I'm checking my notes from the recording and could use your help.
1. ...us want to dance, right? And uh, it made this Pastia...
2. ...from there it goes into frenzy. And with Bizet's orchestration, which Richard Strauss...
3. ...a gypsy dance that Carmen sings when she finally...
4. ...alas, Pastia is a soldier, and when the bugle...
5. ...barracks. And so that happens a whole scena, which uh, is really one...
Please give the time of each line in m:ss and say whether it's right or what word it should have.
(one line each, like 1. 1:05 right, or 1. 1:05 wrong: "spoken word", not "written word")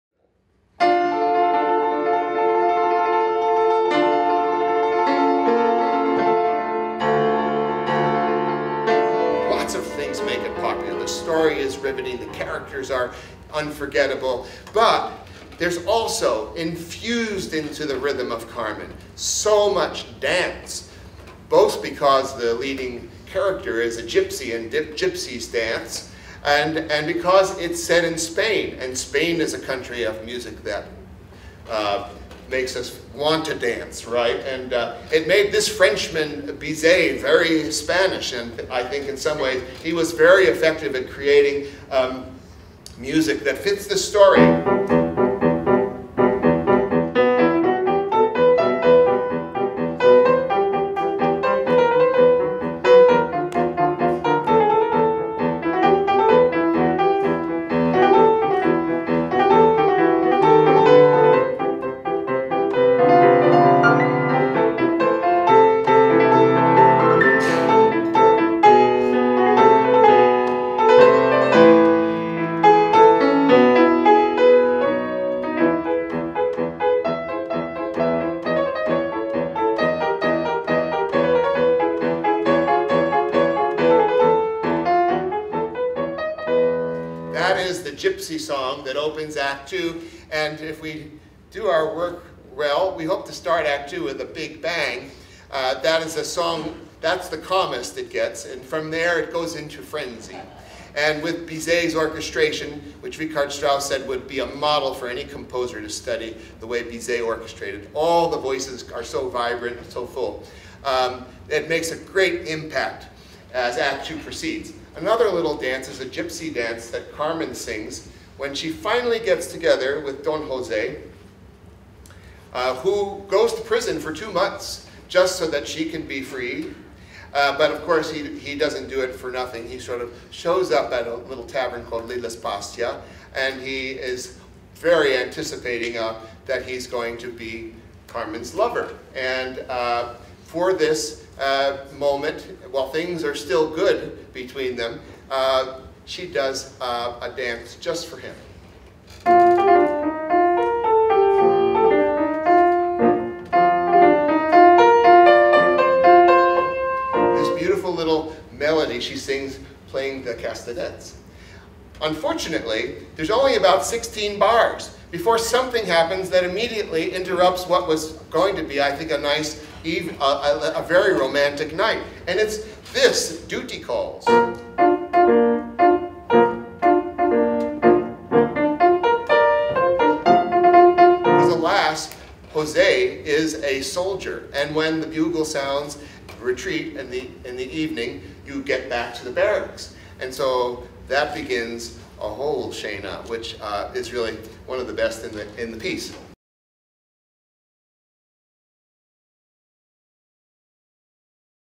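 1. 0:32 wrong: "Frenchman", not "Pastia"
2. 1:38 right
3. 1:55 right
4. 3:01 wrong: "Jose", not "Pastia"
5. 3:09 wrong: "begins", not "happens".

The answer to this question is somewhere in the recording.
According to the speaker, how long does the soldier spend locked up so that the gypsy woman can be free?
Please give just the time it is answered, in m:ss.
2:04.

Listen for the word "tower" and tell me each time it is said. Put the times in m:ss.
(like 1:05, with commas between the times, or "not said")
not said.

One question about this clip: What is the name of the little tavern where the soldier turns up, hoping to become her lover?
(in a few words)
Lilas Pastia.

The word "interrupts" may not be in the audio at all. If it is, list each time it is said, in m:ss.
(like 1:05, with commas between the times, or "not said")
2:47.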